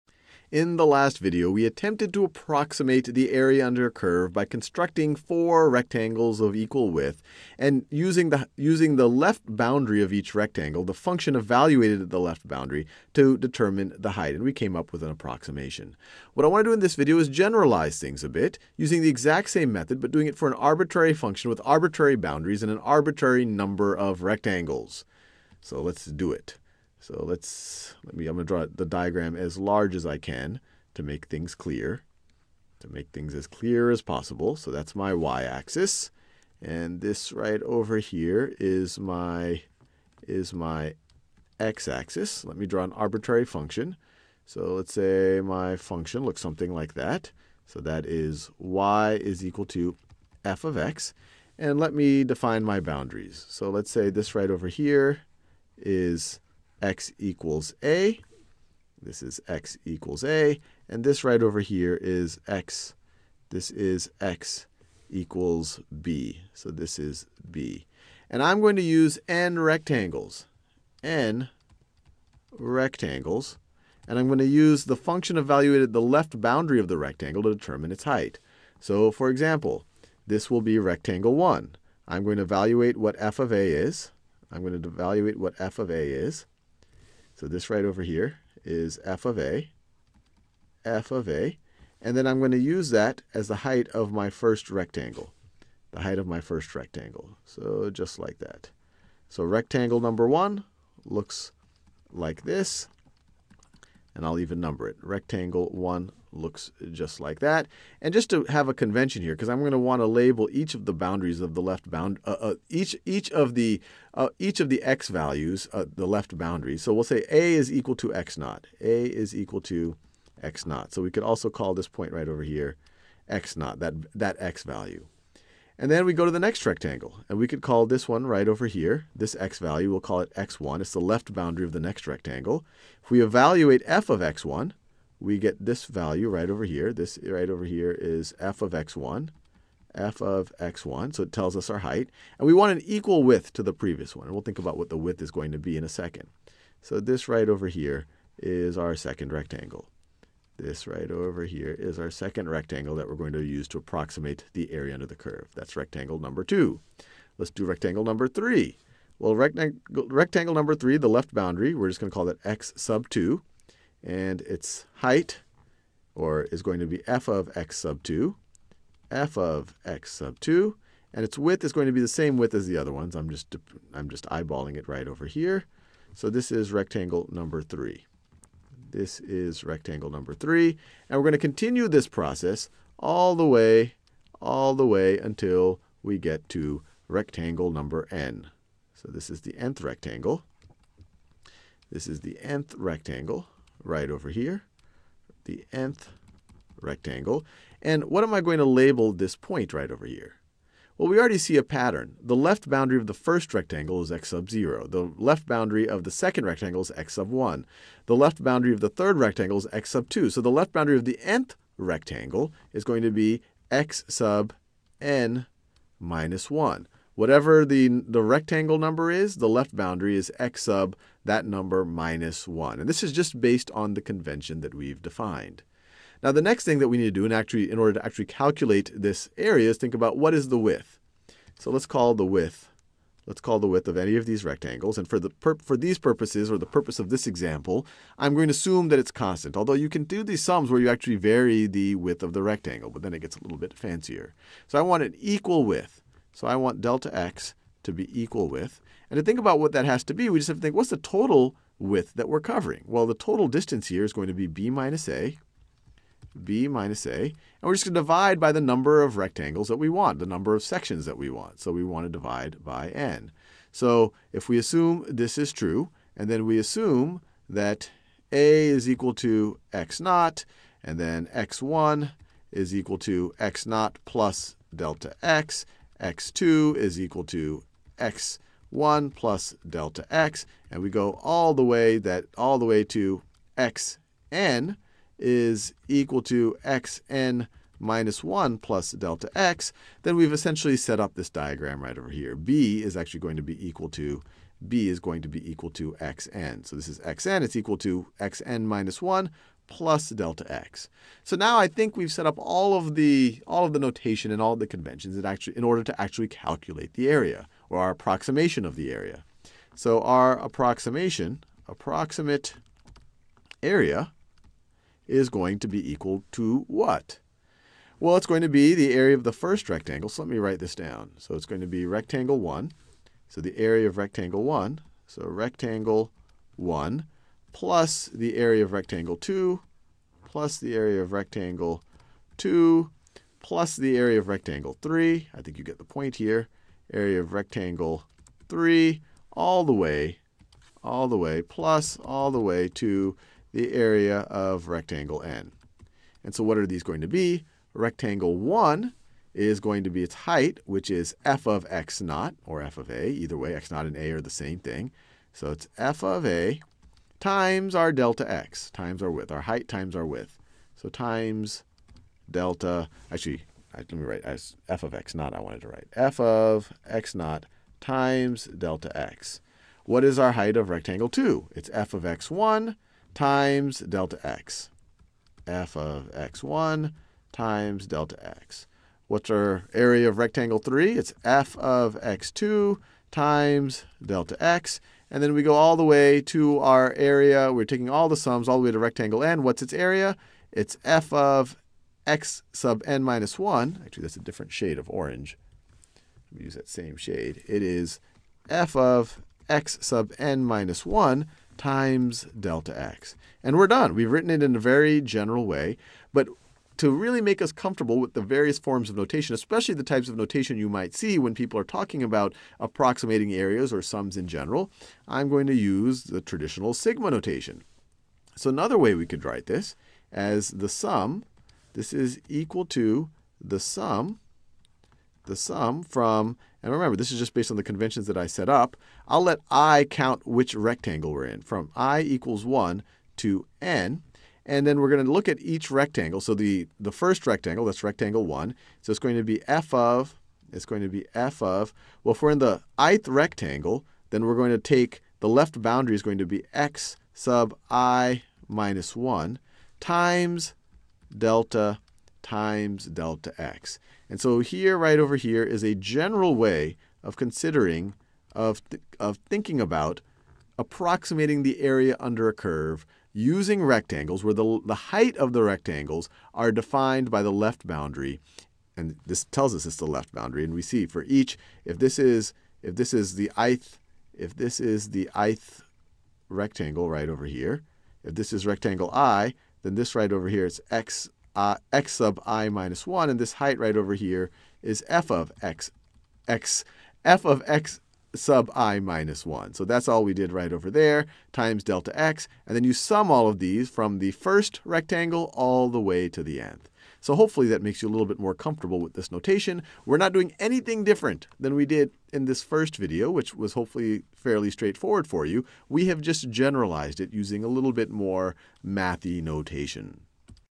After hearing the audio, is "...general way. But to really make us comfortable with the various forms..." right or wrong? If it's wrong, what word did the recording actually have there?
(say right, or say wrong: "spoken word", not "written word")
right.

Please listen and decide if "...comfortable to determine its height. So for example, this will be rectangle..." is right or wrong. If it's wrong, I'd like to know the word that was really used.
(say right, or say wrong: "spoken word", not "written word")
wrong: "rectangle", not "comfortable".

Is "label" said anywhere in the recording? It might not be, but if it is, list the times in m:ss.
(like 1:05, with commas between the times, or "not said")
1:50, 3:18.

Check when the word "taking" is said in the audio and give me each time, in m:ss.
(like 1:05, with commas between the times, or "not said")
6:27.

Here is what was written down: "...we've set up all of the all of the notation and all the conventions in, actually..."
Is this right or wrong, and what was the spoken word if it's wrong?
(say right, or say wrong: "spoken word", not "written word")
right.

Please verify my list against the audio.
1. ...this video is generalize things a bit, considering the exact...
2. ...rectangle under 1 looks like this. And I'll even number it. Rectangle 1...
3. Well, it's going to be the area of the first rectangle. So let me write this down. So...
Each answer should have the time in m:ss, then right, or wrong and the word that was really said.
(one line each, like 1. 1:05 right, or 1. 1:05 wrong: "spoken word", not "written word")
1. 0:16 wrong: "using", not "considering"
2. 1:39 wrong: "number", not "under"
3. 5:17 right.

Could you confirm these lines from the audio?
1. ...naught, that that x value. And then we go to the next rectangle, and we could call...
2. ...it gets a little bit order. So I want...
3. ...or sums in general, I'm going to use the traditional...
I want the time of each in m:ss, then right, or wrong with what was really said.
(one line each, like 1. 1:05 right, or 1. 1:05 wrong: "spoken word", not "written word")
1. 2:03 right
2. 4:03 wrong: "fancier", not "order"
3. 6:53 right.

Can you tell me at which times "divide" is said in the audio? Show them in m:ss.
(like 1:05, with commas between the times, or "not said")
4:17, 4:22.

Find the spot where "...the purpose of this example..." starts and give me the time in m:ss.
3:56.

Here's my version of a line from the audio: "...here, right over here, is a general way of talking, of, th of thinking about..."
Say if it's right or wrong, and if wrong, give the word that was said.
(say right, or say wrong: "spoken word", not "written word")
wrong: "considering", not "talking".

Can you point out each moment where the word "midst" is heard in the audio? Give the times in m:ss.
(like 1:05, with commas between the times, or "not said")
not said.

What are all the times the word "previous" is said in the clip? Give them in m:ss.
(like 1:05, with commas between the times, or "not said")
2:23.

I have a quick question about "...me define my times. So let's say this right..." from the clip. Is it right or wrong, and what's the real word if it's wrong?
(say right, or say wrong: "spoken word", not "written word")
wrong: "boundaries", not "times".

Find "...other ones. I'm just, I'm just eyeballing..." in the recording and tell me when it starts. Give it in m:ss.
2:52.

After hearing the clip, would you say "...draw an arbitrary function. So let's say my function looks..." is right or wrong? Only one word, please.
right.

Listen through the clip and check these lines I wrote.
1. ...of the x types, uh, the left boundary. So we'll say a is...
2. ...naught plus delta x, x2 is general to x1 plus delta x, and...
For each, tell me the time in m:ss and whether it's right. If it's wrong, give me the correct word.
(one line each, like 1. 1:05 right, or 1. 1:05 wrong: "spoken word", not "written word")
1. 1:54 wrong: "values", not "types"
2. 4:33 wrong: "equal", not "general".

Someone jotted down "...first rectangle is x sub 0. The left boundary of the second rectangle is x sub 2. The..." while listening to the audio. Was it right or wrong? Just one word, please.
wrong.